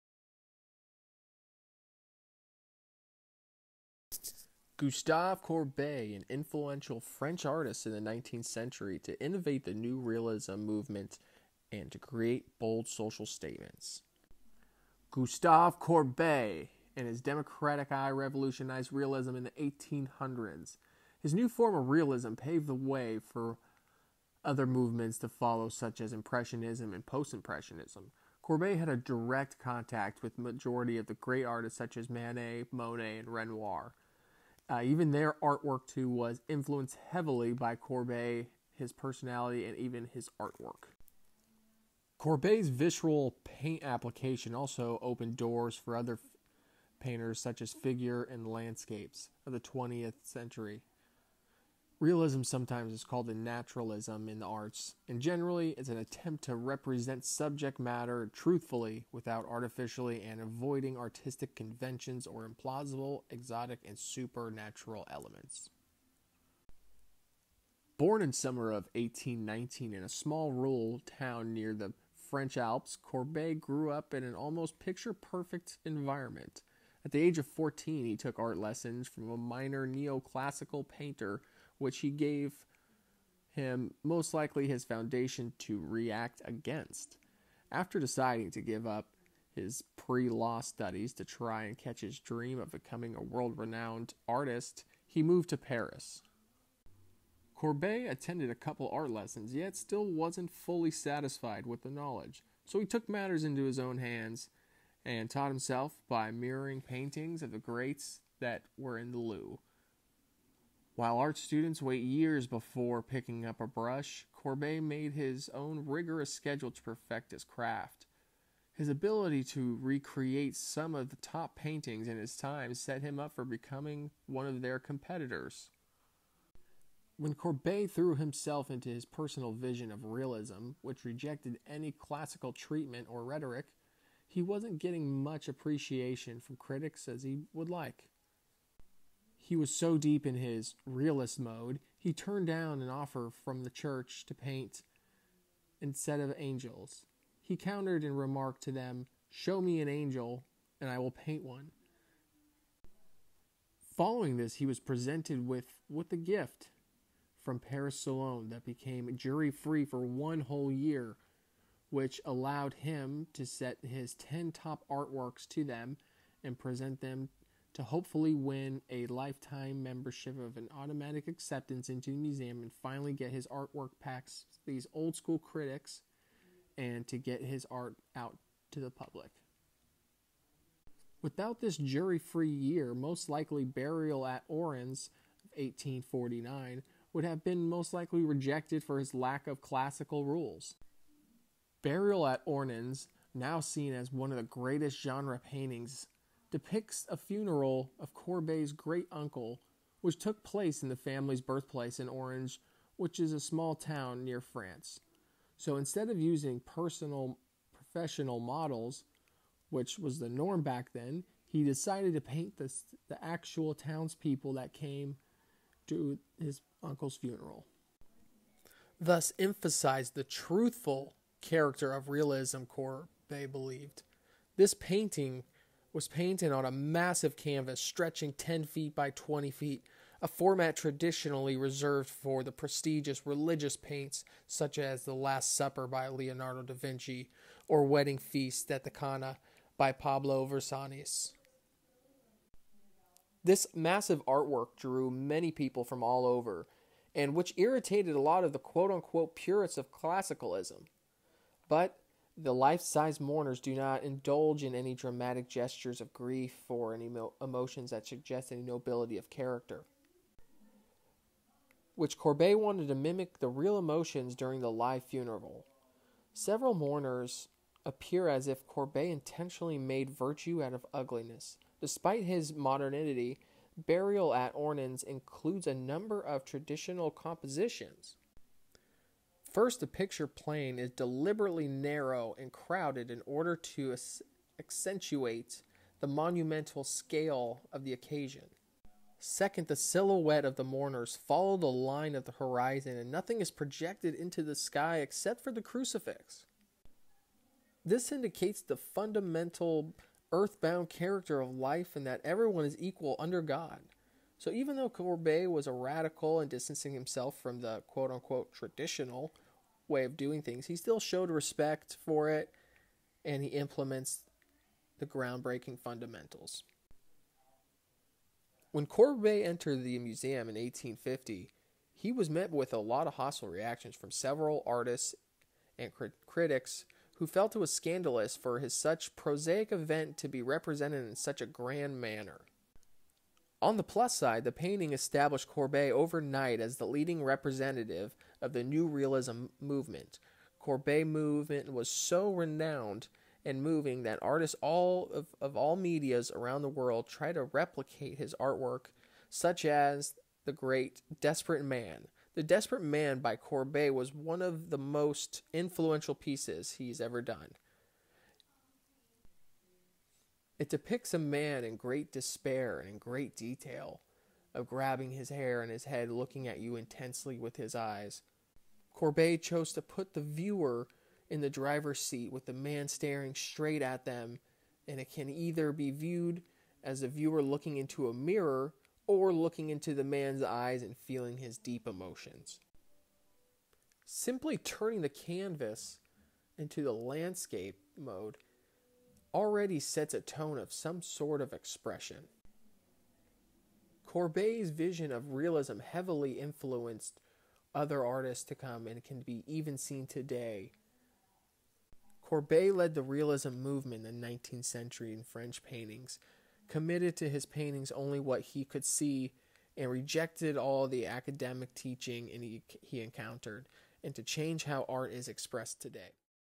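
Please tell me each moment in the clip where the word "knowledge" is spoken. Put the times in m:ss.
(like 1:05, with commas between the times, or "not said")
1:41.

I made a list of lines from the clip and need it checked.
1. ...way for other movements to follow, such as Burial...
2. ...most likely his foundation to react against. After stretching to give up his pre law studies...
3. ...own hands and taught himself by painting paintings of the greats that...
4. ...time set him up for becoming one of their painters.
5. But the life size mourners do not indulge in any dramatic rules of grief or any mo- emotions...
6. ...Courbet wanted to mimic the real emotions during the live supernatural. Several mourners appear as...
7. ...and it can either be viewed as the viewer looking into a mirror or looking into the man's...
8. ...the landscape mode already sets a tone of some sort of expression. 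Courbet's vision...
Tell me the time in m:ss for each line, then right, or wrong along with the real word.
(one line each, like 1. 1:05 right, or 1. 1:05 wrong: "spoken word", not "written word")
1. 0:22 wrong: "Impressionism", not "Burial"
2. 1:24 wrong: "deciding", not "stretching"
3. 1:43 wrong: "mirroring", not "painting"
4. 2:02 wrong: "competitors", not "painters"
5. 4:11 wrong: "gestures", not "rules"
6. 4:22 wrong: "funeral", not "supernatural"
7. 6:14 right
8. 6:26 right.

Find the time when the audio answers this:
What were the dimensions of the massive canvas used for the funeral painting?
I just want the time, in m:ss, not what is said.
3:48.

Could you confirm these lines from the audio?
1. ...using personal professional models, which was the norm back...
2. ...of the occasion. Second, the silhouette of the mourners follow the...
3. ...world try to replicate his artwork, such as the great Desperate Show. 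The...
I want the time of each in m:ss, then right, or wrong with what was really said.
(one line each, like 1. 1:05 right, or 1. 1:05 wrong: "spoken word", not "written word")
1. 3:26 right
2. 4:47 right
3. 5:46 wrong: "Man", not "Show".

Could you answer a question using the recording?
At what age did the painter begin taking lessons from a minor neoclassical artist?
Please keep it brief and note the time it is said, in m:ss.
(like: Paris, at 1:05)
14, at 1:17.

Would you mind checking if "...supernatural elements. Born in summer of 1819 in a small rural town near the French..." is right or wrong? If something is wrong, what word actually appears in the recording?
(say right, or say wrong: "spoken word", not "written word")
right.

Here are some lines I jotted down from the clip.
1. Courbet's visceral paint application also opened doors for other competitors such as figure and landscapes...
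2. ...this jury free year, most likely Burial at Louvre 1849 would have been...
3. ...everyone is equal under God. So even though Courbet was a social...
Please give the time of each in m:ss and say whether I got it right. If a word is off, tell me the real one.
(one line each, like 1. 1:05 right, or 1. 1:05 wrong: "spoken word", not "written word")
1. 0:42 wrong: "painters", not "competitors"
2. 3:01 wrong: "Ornans", not "Louvre"
3. 5:02 wrong: "radical", not "social".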